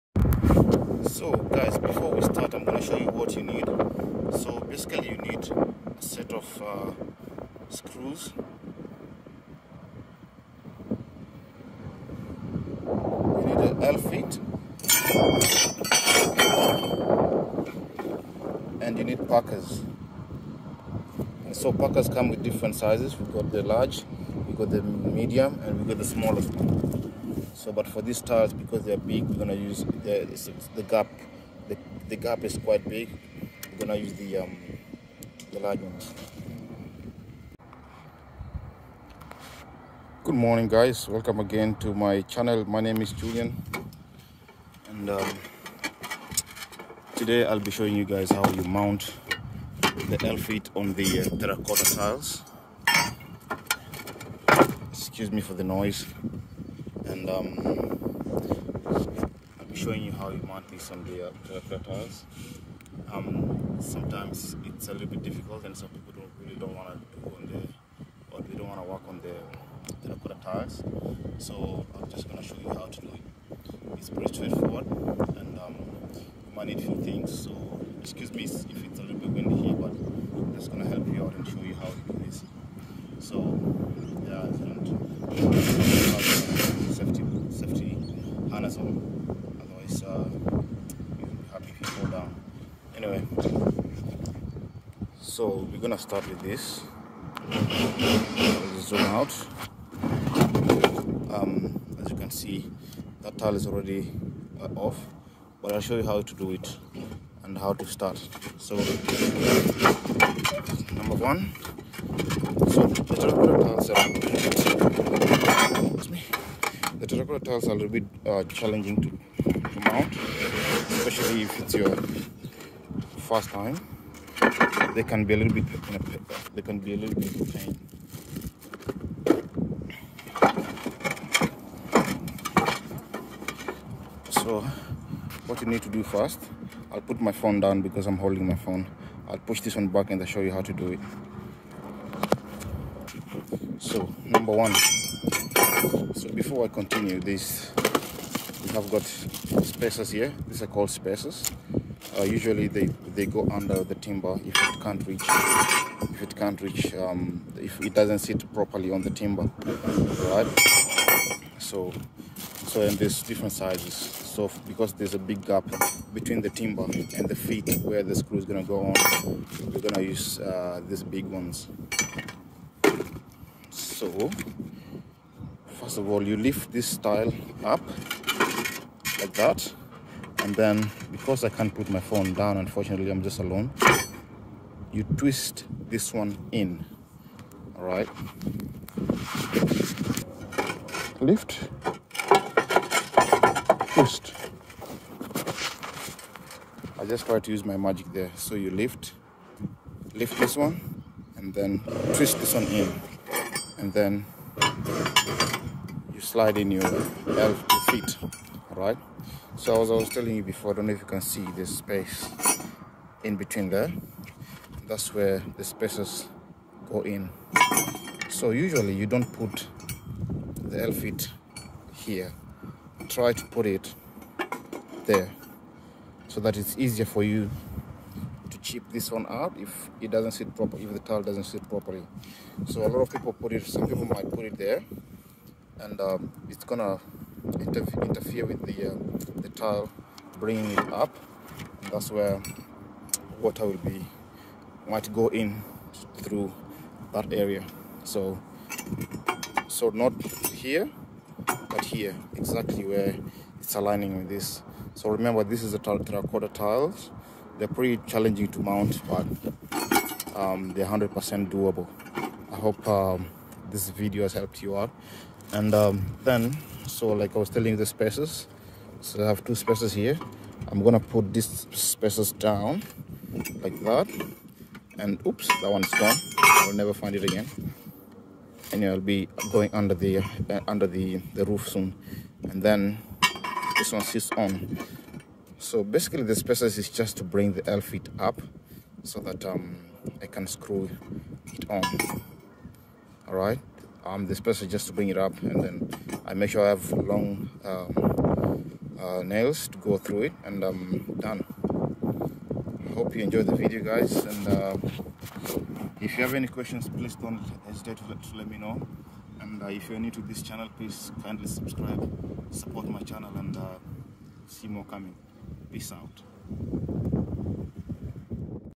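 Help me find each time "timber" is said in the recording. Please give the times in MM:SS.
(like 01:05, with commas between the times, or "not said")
02:33, 02:39, 02:46.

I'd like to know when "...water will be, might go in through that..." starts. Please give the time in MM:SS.
04:03.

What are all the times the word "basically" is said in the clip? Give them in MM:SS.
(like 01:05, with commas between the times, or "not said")
00:04, 04:45.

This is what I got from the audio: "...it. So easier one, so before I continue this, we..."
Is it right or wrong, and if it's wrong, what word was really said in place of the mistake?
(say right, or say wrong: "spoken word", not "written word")
wrong: "number", not "easier".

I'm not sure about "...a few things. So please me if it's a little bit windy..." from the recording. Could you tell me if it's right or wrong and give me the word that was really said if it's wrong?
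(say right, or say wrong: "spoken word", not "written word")
wrong: "excuse", not "please".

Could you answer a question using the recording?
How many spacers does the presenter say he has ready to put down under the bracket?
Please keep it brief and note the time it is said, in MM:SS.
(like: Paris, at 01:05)
2, at 04:29.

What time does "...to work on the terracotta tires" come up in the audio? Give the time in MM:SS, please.
01:08.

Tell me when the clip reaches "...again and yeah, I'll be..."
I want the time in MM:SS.
04:37.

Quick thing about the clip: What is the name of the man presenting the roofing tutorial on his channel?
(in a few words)
Julian.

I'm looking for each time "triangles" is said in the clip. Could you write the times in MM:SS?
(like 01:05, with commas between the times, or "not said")
not said.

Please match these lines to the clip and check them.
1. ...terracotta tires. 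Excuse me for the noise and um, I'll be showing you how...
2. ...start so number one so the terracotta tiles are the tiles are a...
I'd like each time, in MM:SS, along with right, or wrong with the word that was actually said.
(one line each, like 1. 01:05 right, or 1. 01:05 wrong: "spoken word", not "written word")
1. 00:51 wrong: "tiles", not "tires"
2. 01:47 right.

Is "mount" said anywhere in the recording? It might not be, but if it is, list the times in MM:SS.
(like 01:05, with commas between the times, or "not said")
00:48, 01:00, 01:59, 04:18.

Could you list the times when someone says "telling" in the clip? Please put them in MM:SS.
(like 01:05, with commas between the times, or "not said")
03:30, 04:27.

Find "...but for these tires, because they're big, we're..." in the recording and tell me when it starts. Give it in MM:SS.
00:27.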